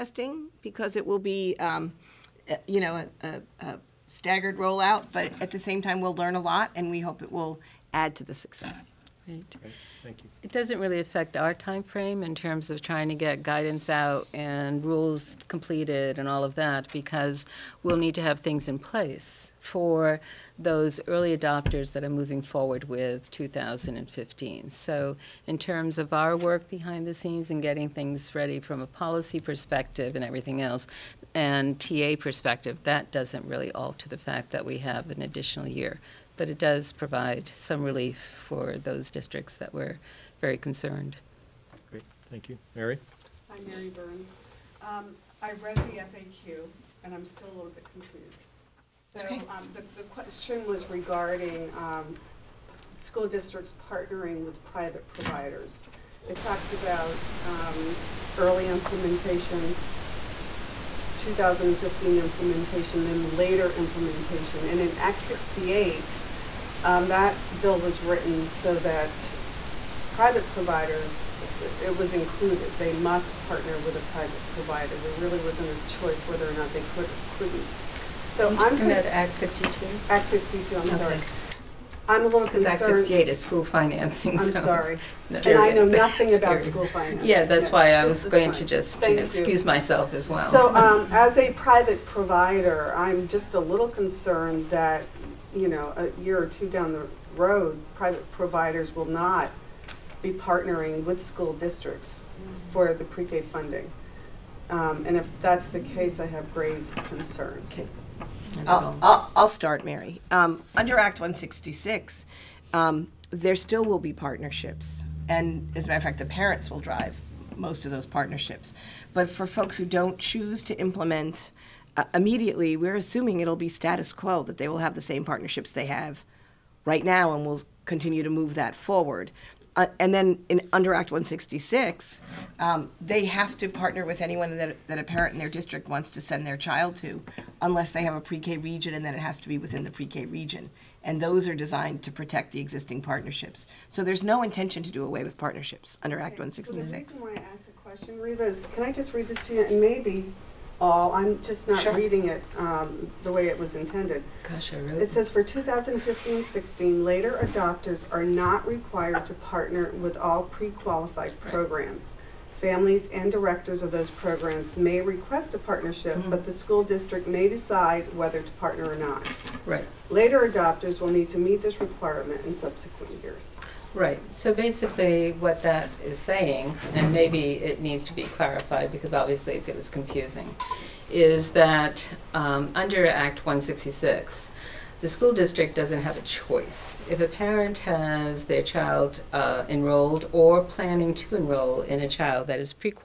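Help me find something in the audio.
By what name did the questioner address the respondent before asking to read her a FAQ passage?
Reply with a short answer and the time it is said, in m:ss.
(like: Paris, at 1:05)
Reeva, at 2:28.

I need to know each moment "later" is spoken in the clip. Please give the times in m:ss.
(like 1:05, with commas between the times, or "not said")
1:03, 2:37, 2:50.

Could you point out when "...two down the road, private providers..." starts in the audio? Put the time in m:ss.
1:36.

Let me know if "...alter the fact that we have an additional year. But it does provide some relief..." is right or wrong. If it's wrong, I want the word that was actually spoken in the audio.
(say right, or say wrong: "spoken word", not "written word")
right.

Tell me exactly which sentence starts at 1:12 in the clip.
They must partner with a private provider.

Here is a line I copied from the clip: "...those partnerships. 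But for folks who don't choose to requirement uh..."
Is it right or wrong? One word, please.
wrong.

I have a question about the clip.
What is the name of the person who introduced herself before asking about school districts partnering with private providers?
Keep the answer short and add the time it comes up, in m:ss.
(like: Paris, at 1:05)
Mary Burns, at 0:43.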